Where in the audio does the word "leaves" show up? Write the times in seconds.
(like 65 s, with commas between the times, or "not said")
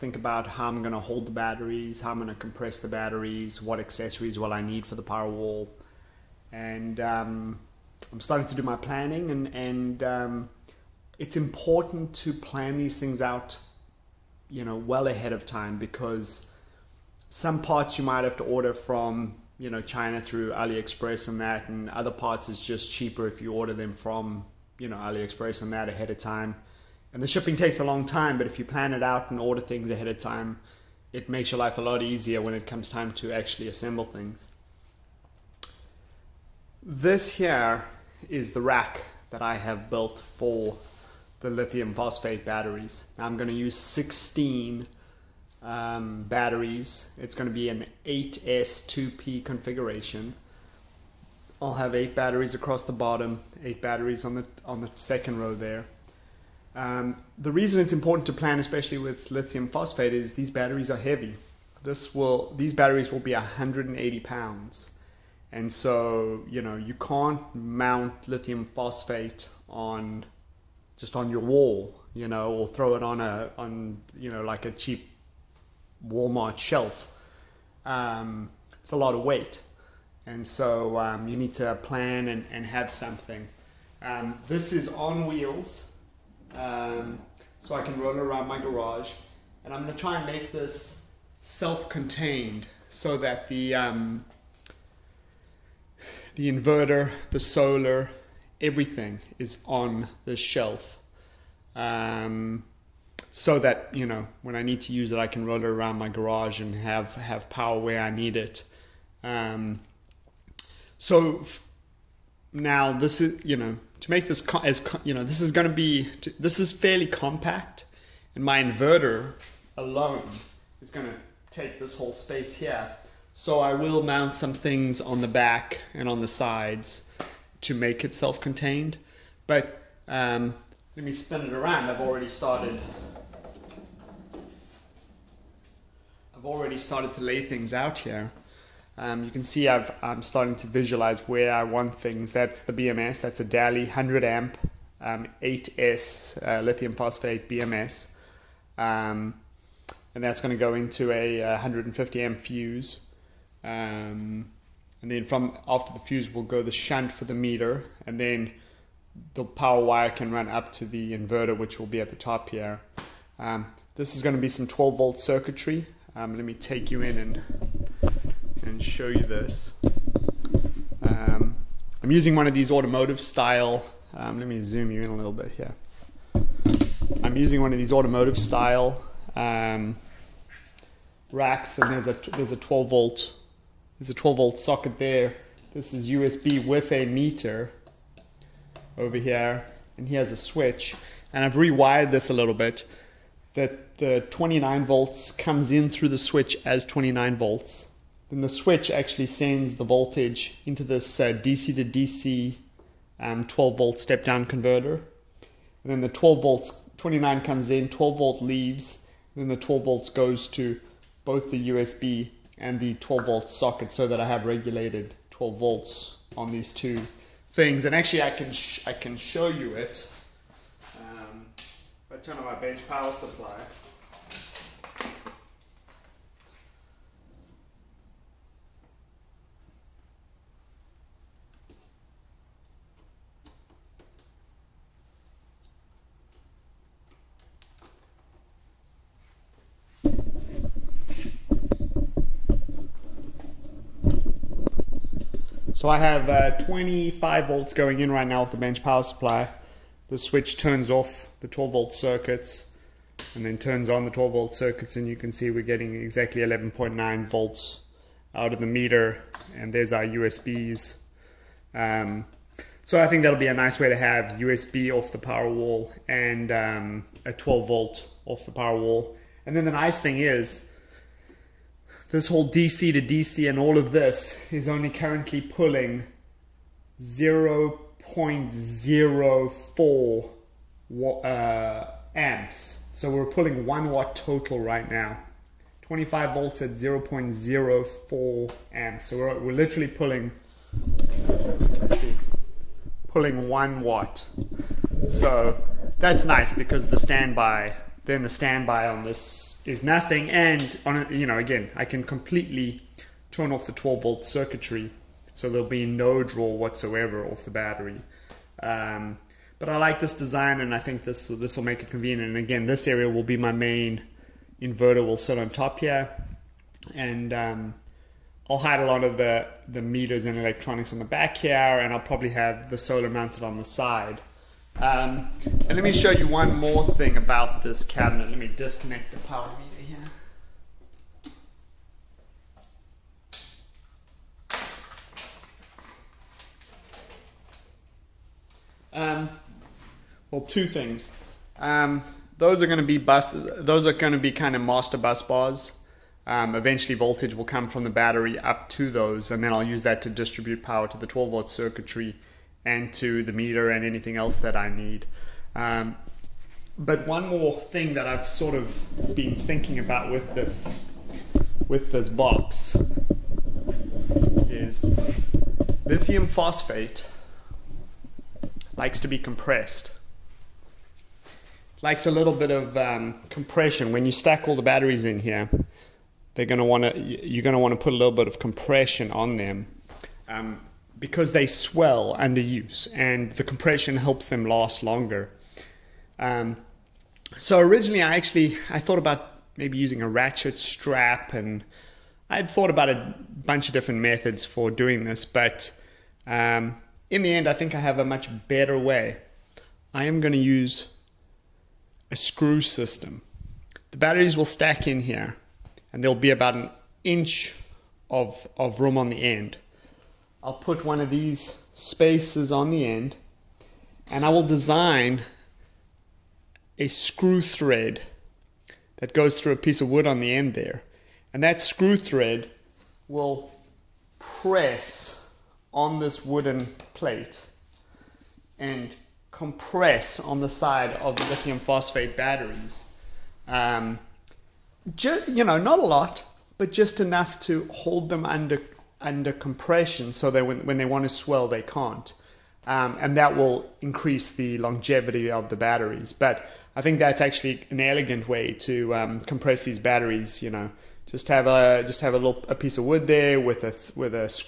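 208 s.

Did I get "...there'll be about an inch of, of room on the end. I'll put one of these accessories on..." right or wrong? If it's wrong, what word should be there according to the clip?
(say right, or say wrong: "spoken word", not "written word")
wrong: "spaces", not "accessories".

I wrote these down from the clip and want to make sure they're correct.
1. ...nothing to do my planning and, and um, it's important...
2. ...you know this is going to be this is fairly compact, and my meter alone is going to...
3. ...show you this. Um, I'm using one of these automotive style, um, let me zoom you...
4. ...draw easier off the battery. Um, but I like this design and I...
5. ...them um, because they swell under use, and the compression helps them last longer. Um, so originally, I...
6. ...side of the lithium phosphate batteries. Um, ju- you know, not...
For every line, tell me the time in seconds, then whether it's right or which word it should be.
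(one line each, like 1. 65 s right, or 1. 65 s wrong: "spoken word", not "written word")
1. 8 s wrong: "starting", not "nothing"
2. 115 s wrong: "inverter", not "meter"
3. 168 s right
4. 306 s wrong: "whatsoever", not "easier"
5. 379 s right
6. 430 s right.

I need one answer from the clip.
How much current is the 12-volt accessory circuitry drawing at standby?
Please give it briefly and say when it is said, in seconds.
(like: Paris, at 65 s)
0.04 amps, at 278 s.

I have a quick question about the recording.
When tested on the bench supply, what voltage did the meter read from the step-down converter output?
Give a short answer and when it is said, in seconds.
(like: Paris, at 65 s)
11.9 volts, at 256 s.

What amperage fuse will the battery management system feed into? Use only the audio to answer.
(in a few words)
150 amp.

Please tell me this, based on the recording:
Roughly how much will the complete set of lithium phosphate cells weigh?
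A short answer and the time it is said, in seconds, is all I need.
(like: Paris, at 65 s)
180 pounds, at 63 s.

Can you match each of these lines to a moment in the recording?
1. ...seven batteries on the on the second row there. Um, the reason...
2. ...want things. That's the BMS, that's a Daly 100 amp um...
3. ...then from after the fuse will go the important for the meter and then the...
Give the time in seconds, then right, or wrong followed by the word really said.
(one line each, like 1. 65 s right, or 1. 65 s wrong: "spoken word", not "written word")
1. 53 s wrong: "eight", not "seven"
2. 141 s right
3. 155 s wrong: "shunt", not "important".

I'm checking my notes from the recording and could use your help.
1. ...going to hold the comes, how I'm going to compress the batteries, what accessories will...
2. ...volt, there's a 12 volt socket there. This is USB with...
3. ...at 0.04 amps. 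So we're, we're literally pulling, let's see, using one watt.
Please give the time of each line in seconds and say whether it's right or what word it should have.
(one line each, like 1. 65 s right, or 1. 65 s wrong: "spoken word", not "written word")
1. 0 s wrong: "batteries", not "comes"
2. 182 s right
3. 286 s wrong: "pulling", not "using".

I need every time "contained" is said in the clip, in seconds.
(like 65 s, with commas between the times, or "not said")
91 s, 128 s.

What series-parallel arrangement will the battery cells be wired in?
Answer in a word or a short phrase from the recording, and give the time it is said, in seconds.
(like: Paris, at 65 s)
8S2P, at 48 s.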